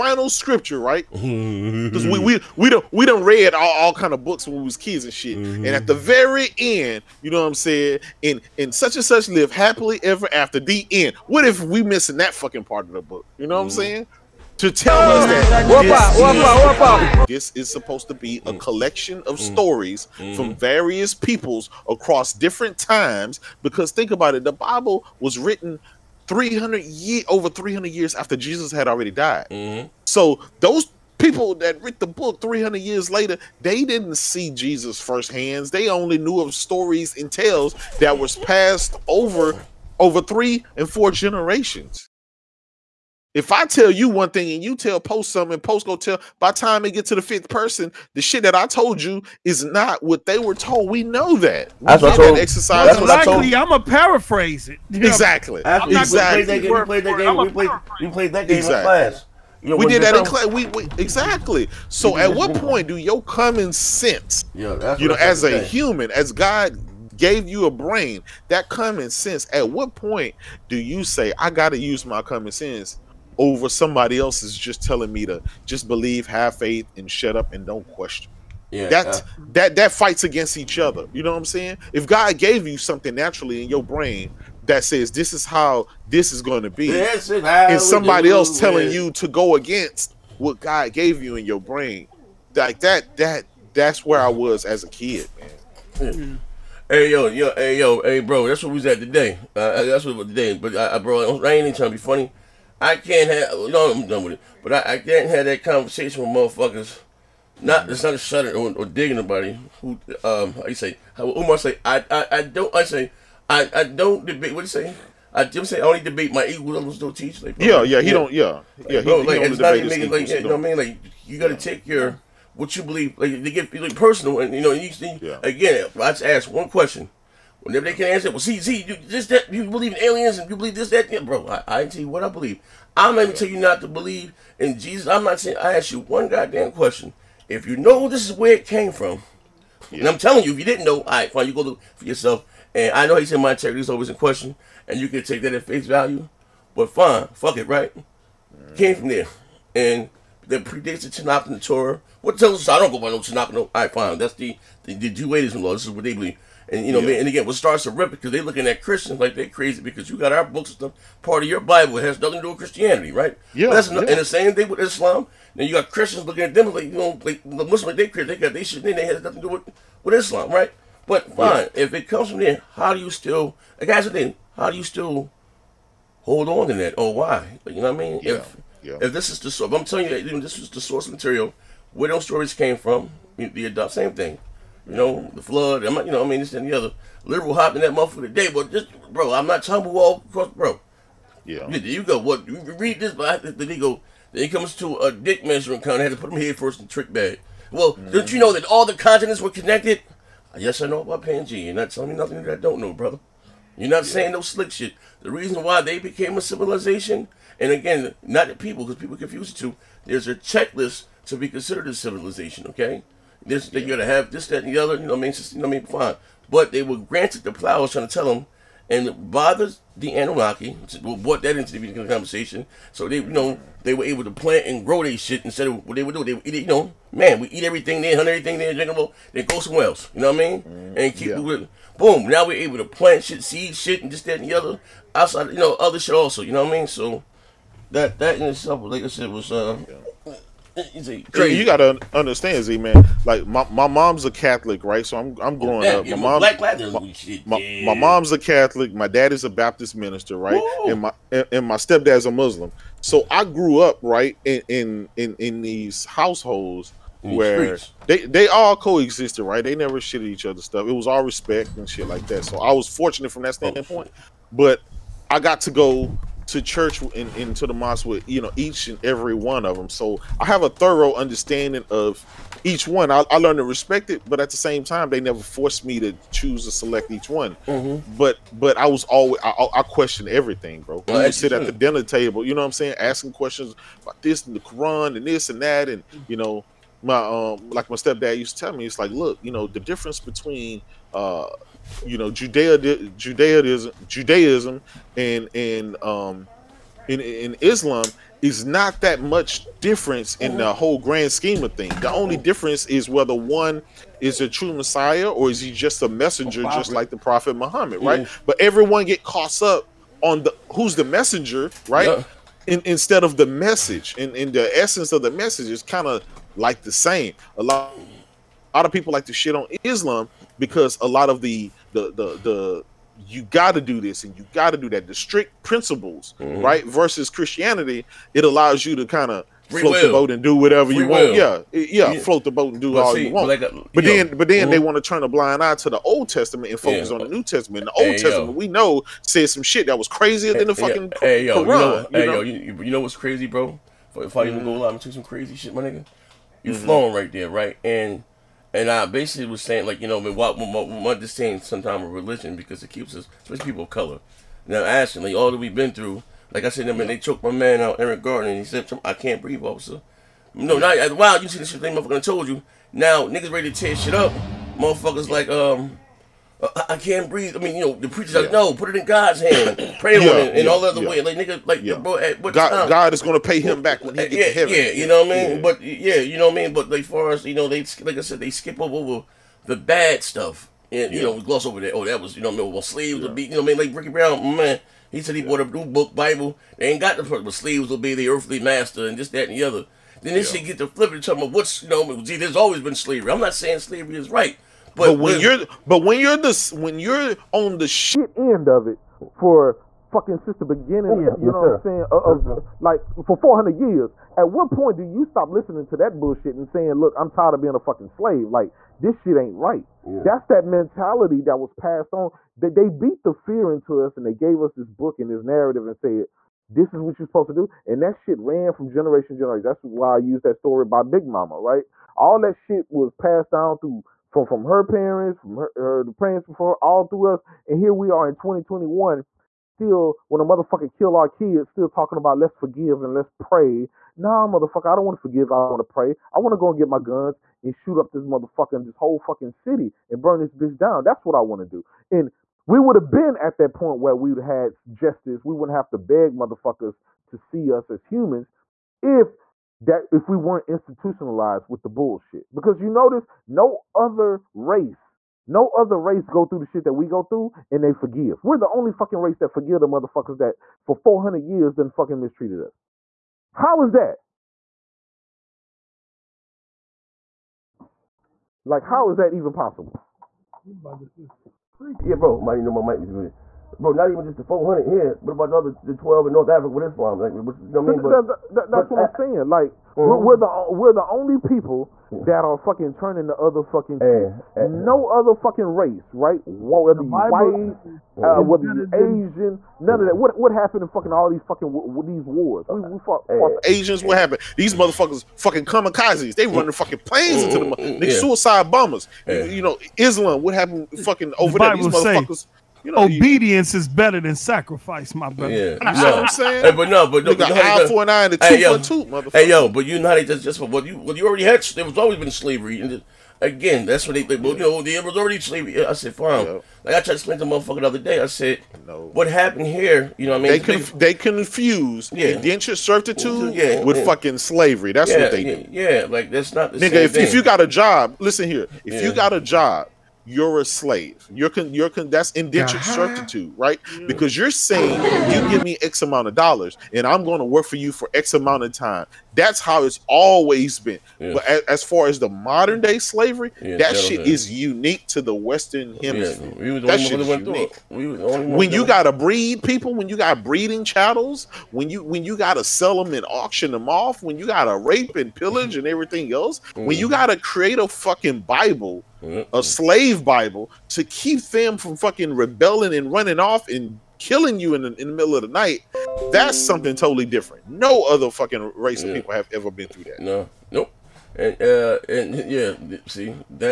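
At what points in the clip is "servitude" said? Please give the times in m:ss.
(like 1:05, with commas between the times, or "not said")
8:42, 8:53.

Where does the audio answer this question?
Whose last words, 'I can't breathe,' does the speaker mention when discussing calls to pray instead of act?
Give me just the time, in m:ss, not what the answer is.
5:57.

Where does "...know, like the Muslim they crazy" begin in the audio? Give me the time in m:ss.
2:46.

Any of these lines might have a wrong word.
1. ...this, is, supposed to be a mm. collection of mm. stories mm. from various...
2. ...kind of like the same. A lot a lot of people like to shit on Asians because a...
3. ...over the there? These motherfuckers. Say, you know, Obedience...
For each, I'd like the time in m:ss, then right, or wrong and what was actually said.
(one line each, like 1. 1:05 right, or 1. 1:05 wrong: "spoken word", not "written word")
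1. 0:17 right
2. 5:15 wrong: "Islam", not "Asians"
3. 8:21 right.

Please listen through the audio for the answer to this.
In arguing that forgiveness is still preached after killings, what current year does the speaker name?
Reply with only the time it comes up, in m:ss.
7:08.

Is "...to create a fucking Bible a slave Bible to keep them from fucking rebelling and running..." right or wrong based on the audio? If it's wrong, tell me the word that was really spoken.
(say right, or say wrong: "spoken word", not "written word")
right.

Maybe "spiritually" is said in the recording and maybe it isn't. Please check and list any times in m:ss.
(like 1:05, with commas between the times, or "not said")
not said.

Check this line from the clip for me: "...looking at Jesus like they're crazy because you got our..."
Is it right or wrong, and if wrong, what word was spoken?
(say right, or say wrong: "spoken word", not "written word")
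wrong: "Christians", not "Jesus".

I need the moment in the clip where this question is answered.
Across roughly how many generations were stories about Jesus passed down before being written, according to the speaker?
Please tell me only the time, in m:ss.
0:40.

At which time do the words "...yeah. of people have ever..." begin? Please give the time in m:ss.
9:29.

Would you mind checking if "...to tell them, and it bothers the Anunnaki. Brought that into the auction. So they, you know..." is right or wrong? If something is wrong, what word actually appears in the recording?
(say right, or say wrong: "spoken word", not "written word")
wrong: "conversation", not "auction".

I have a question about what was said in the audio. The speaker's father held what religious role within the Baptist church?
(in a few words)
Minister.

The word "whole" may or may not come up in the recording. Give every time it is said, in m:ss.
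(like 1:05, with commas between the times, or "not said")
5:00, 7:18.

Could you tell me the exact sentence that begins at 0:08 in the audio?
And and such and such live happily ever after.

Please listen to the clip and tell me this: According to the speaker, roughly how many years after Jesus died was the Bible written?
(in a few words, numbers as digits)
over 300 years.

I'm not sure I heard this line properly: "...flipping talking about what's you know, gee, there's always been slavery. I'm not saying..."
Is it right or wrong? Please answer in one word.
right.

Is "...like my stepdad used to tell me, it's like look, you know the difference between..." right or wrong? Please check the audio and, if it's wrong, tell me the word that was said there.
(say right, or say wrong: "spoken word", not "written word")
right.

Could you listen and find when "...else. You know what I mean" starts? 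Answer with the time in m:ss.
3:49.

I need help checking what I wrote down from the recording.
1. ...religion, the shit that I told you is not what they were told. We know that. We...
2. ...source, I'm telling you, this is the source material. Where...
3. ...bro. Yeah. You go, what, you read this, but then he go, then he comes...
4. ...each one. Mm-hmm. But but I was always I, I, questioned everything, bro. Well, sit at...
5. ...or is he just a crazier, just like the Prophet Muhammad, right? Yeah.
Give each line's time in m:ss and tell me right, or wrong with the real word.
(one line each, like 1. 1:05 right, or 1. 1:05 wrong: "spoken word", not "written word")
1. 0:47 wrong: "person", not "religion"
2. 2:59 right
3. 3:10 right
4. 4:37 right
5. 5:05 wrong: "messenger", not "crazier".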